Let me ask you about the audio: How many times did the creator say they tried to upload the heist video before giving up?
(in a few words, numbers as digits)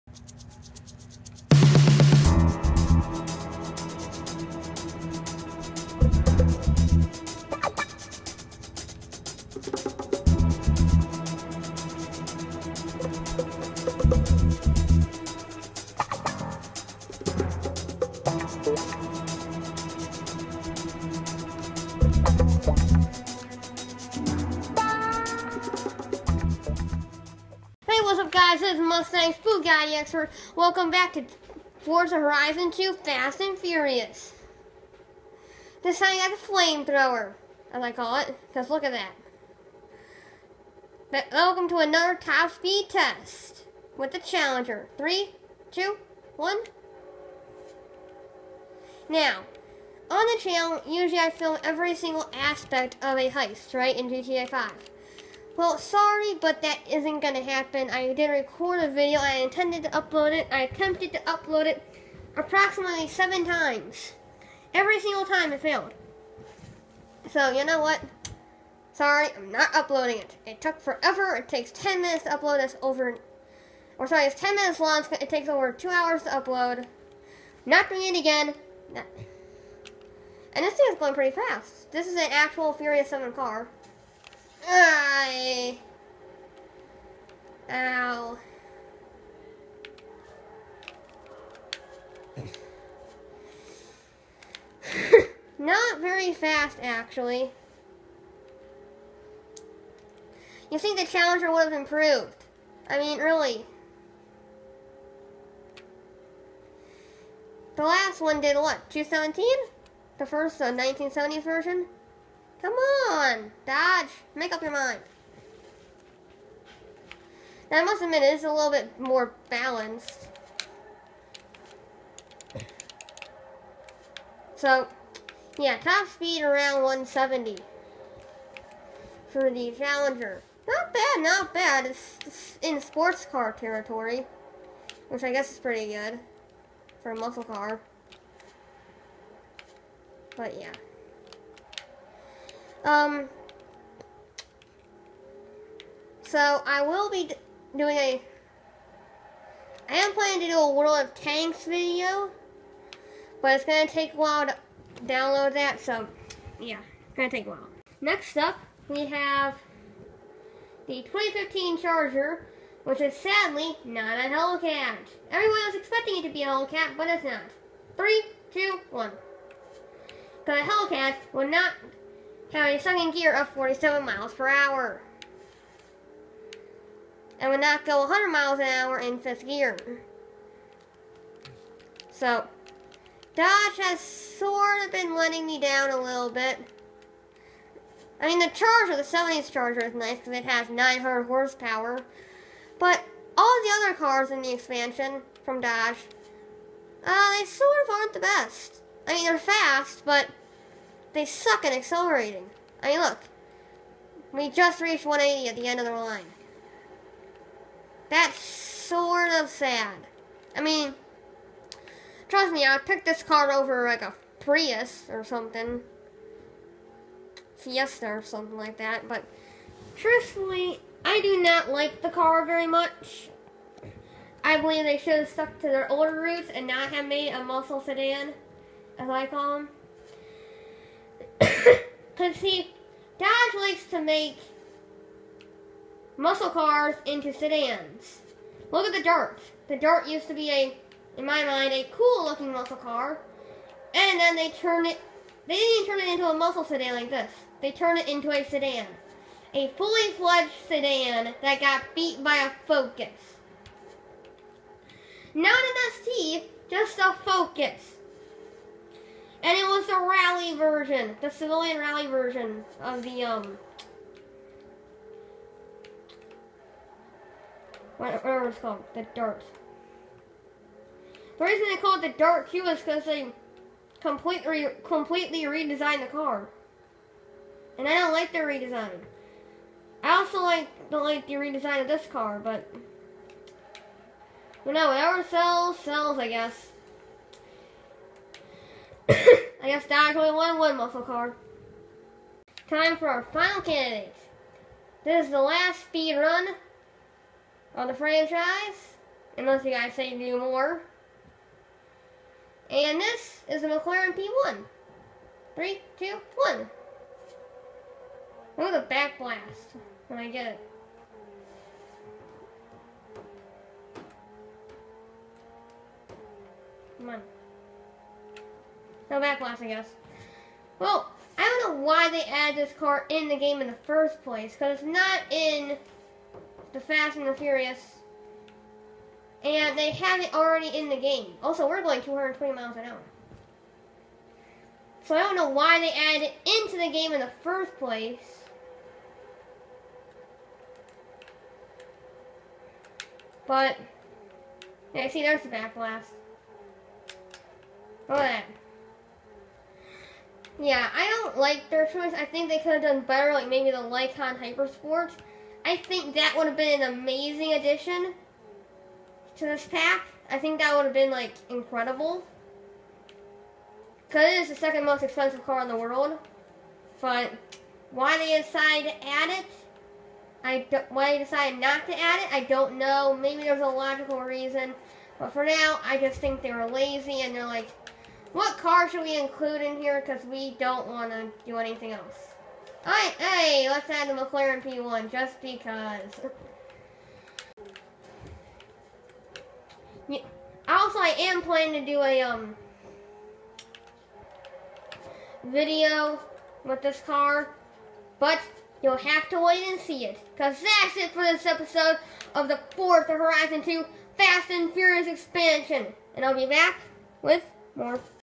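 7.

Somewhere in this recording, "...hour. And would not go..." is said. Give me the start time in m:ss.
2:54.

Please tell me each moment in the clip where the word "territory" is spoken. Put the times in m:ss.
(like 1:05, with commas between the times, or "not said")
2:13.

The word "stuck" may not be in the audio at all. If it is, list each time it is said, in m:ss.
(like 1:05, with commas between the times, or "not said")
3:45.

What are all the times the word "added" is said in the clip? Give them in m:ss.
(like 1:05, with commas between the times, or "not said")
5:22, 5:35.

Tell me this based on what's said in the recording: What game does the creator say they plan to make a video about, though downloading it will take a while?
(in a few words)
World of Tanks.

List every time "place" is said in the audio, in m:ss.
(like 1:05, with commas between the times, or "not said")
5:24, 5:37.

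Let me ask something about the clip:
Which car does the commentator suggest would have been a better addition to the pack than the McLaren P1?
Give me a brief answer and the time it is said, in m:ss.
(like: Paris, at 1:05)
Lykan HyperSport, at 5:53.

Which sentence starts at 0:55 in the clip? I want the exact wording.
Well, sorry, but that isn't gonna happen.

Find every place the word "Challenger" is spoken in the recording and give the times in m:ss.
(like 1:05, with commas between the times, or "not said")
0:44, 1:41, 2:09.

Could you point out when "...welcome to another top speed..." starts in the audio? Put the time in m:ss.
0:41.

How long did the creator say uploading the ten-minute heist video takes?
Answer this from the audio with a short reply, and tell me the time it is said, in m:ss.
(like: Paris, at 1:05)
over 2 hours, at 1:15.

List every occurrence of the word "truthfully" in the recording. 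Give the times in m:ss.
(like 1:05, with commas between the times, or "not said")
3:39.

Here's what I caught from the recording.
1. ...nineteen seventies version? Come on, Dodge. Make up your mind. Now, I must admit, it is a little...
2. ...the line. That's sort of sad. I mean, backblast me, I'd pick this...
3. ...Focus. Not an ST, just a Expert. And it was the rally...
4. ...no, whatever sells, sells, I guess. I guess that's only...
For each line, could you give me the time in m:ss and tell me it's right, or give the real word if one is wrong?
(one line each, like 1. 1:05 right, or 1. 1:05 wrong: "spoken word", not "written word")
1. 1:50 right
2. 3:25 wrong: "trust", not "backblast"
3. 4:12 wrong: "Focus", not "Expert"
4. 4:44 right.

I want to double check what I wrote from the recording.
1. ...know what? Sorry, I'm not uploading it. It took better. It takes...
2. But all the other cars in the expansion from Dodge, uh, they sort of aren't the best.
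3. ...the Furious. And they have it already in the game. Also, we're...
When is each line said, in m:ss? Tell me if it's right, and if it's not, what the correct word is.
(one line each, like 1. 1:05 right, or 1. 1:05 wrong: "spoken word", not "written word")
1. 1:07 wrong: "forever", not "better"
2. 3:12 right
3. 5:27 right.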